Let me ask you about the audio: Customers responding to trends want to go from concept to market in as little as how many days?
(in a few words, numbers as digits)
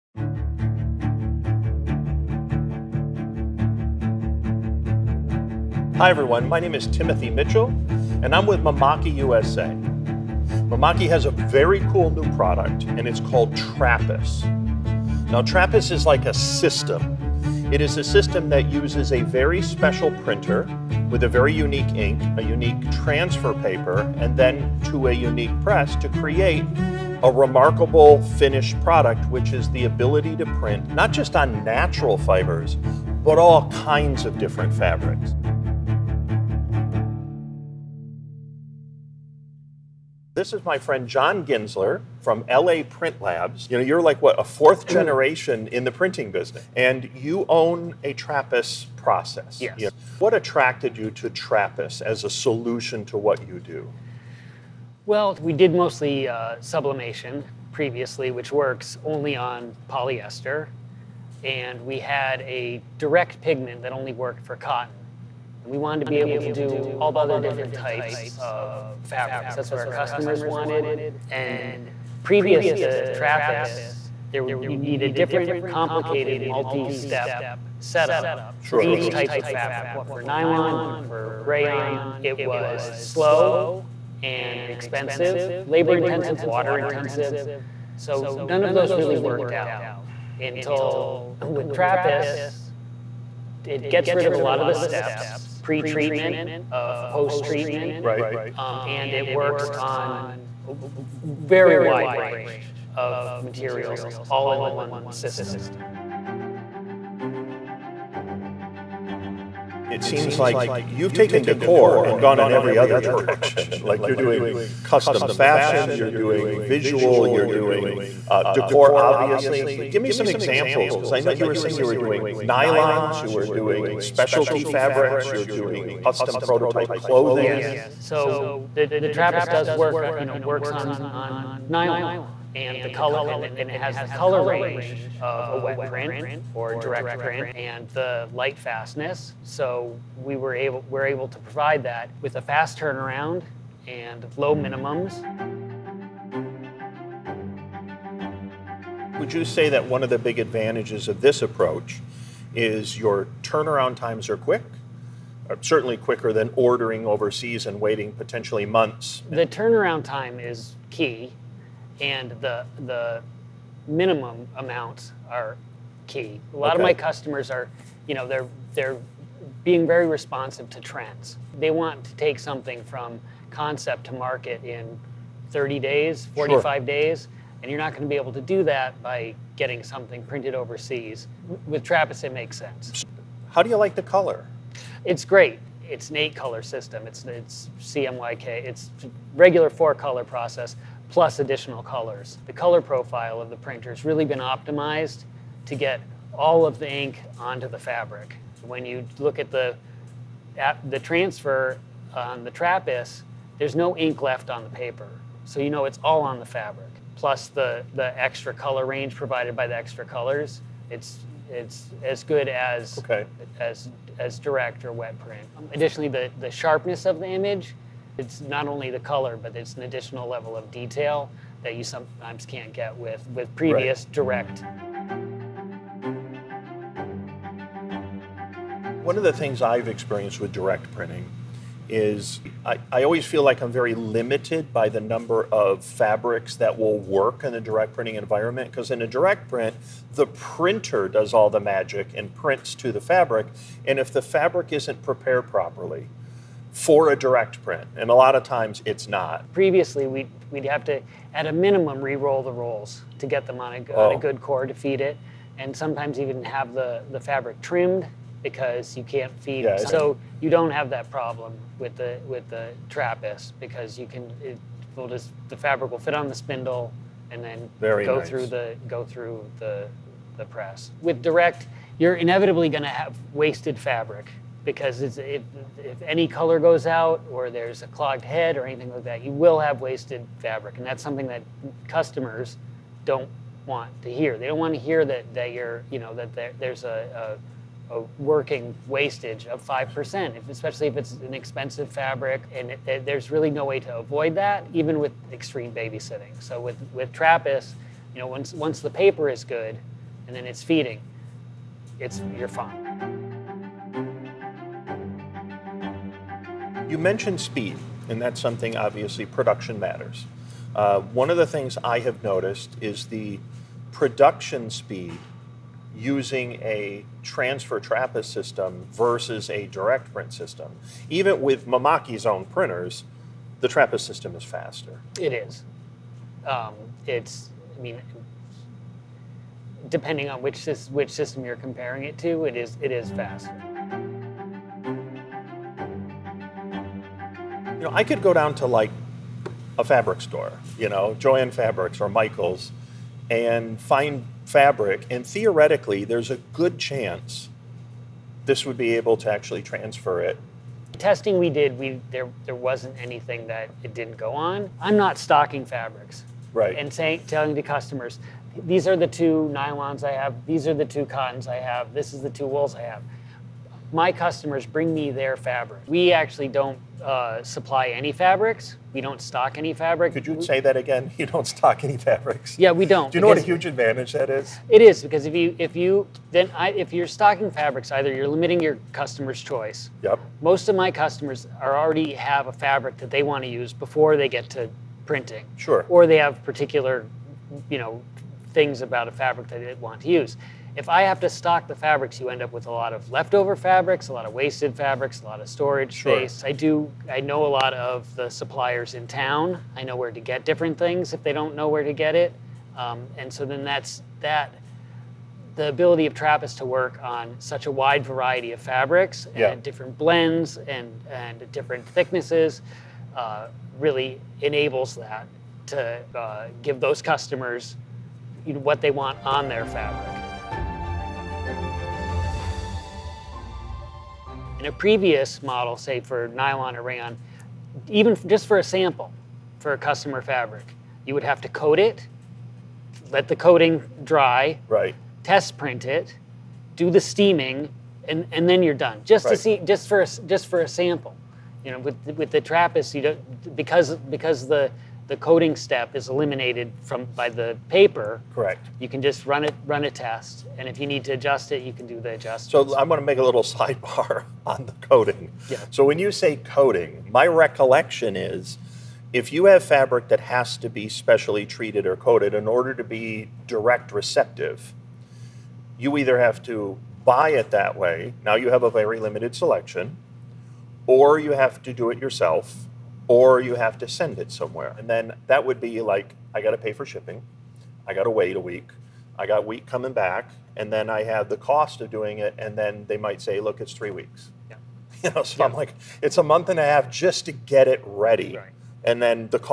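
30.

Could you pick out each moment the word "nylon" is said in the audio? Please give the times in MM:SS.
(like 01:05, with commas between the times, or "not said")
01:20, 02:02, 02:11, 05:59, 07:06.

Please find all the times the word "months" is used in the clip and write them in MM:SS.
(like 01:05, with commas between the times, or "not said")
02:38, 08:06.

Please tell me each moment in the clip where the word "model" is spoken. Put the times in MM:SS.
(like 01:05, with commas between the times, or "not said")
07:05.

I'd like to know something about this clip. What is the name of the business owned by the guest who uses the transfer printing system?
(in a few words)
LA Print Labs.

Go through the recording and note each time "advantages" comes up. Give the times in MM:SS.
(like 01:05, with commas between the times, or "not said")
02:30, 06:13.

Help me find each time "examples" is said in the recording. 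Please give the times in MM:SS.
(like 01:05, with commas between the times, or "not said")
02:00.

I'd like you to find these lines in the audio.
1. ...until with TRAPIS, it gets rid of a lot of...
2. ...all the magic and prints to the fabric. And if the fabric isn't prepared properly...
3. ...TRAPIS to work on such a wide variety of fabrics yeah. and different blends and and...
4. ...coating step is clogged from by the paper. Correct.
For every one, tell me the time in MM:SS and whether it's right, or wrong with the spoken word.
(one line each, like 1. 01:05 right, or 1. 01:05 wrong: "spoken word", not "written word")
1. 01:30 right
2. 04:01 right
3. 06:46 right
4. 07:25 wrong: "eliminated", not "clogged".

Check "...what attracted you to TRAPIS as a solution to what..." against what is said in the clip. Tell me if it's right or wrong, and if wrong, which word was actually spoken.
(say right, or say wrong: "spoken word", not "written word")
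right.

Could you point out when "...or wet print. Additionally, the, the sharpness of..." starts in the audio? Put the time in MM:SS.
03:34.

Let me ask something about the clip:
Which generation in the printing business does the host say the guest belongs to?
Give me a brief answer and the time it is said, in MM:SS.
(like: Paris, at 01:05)
fourth, at 00:44.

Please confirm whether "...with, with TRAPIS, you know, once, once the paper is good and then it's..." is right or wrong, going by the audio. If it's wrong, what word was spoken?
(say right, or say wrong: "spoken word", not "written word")
right.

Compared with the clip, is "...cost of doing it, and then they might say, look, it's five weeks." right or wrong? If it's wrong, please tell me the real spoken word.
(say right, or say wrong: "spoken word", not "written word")
wrong: "three", not "five".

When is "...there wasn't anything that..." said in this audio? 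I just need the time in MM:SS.
05:52.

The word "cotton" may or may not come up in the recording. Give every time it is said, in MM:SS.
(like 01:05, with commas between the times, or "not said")
01:04, 06:01.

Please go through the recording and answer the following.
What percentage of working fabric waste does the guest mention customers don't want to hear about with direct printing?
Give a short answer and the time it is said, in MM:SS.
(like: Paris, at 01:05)
5%, at 04:49.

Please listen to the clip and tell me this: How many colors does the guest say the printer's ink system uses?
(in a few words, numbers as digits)
8.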